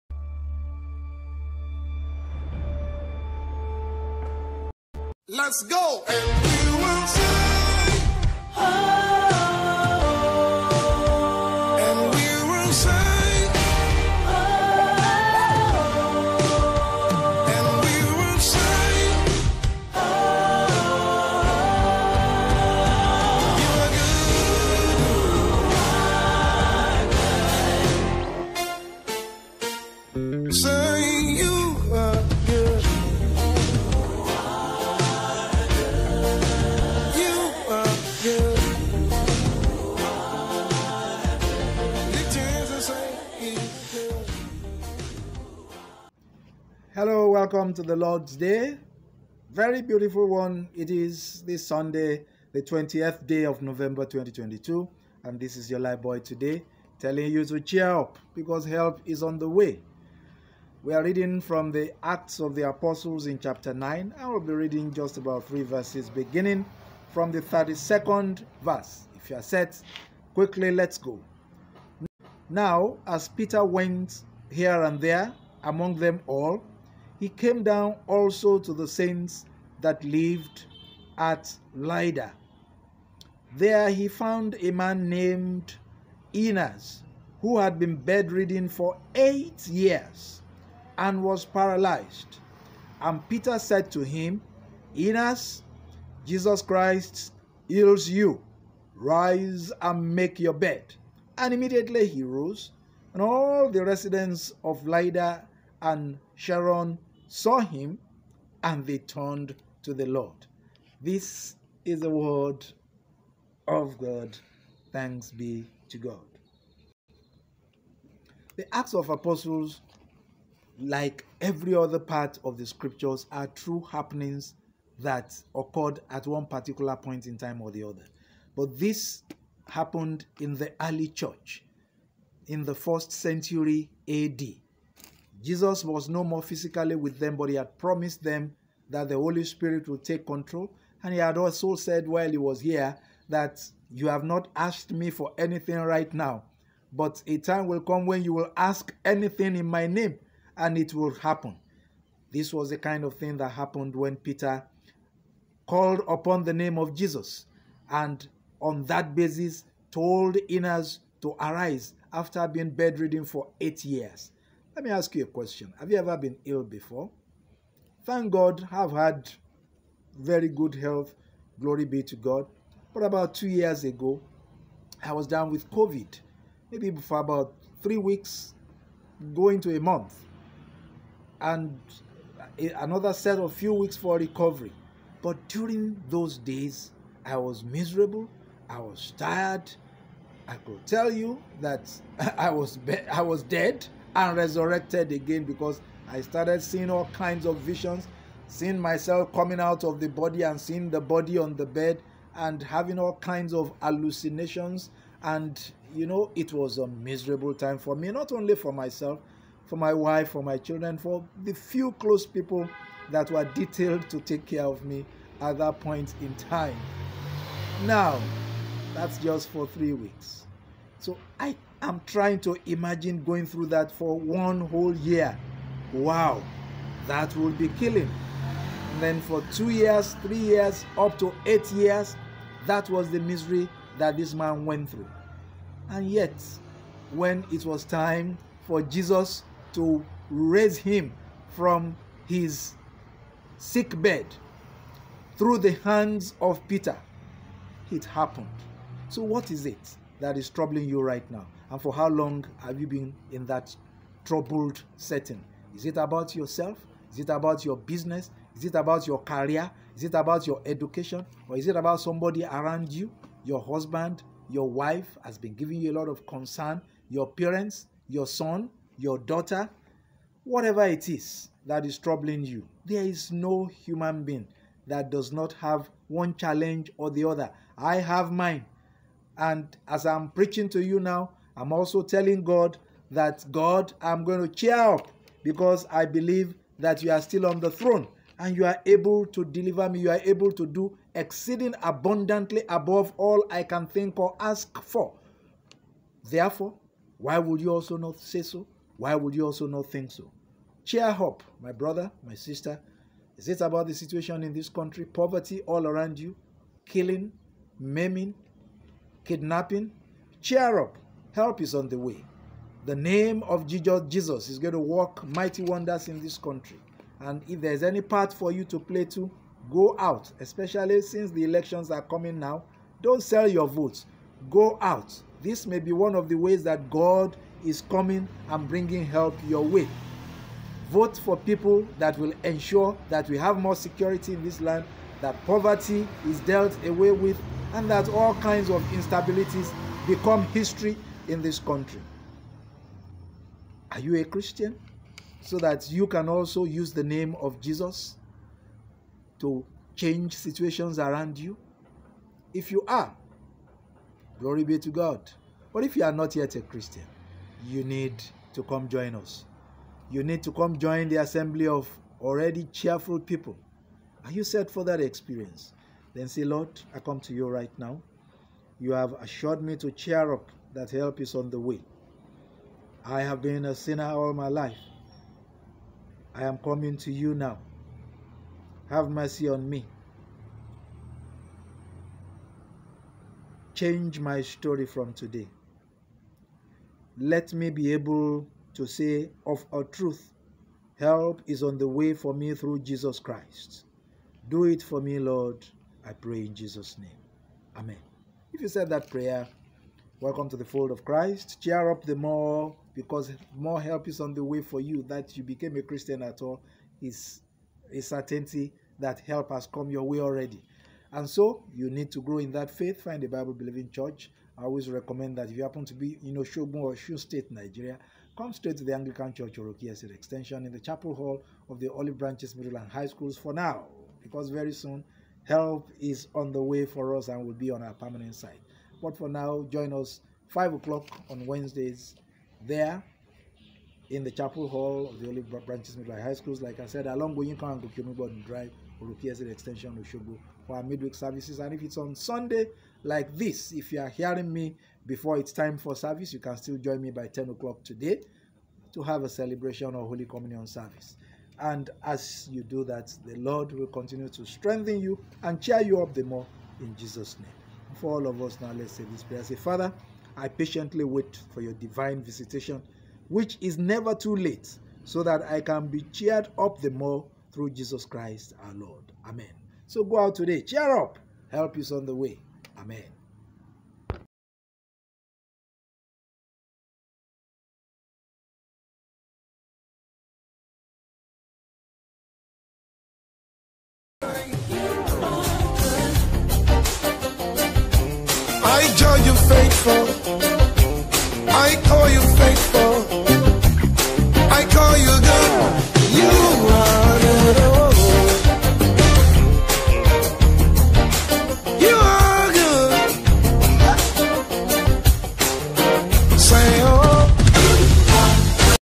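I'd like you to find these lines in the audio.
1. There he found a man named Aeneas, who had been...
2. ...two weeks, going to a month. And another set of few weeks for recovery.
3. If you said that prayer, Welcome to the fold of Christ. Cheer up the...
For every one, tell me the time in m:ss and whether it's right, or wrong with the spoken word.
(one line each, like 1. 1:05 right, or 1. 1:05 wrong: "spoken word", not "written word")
1. 1:23 right
2. 2:57 wrong: "three", not "two"
3. 6:38 right.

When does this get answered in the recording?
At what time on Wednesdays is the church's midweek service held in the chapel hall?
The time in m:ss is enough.
7:10.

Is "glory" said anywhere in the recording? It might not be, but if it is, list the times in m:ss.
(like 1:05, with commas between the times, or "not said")
2:51, 5:54.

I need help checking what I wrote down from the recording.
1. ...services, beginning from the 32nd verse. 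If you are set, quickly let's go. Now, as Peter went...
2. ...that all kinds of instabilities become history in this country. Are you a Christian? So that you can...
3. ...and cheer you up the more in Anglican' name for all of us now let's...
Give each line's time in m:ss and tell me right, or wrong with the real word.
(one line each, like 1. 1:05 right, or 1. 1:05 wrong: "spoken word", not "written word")
1. 1:05 wrong: "verses", not "services"
2. 5:37 right
3. 7:35 wrong: "Jesus", not "Anglican".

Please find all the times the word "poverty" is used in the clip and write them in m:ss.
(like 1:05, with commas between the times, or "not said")
5:05, 5:35.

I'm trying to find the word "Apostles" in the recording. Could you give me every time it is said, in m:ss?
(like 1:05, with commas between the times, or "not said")
1:02, 1:59.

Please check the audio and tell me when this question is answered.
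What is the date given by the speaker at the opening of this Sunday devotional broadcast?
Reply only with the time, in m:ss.
0:52.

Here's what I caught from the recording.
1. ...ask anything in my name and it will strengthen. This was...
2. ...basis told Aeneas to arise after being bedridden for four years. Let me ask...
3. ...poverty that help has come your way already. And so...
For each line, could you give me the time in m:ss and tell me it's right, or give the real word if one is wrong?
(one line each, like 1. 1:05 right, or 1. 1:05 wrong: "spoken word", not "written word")
1. 2:28 wrong: "happen", not "strengthen"
2. 2:39 wrong: "eight", not "four"
3. 6:48 wrong: "certainty", not "poverty".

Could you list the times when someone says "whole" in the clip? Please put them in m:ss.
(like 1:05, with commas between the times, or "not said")
3:44.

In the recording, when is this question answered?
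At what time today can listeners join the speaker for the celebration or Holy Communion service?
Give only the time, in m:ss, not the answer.
7:27.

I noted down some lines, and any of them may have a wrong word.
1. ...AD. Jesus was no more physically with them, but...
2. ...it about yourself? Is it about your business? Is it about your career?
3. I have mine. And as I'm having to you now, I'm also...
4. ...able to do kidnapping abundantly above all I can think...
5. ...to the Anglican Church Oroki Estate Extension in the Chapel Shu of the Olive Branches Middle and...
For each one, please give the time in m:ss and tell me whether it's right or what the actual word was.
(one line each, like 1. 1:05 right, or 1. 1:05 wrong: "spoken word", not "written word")
1. 2:14 right
2. 4:15 right
3. 4:37 wrong: "preaching", not "having"
4. 4:50 wrong: "exceeding", not "kidnapping"
5. 6:58 wrong: "Hall", not "Shu".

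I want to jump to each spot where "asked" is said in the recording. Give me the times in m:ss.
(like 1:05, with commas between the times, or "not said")
2:24.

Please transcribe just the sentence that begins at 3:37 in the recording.
Now, that's just for three weeks.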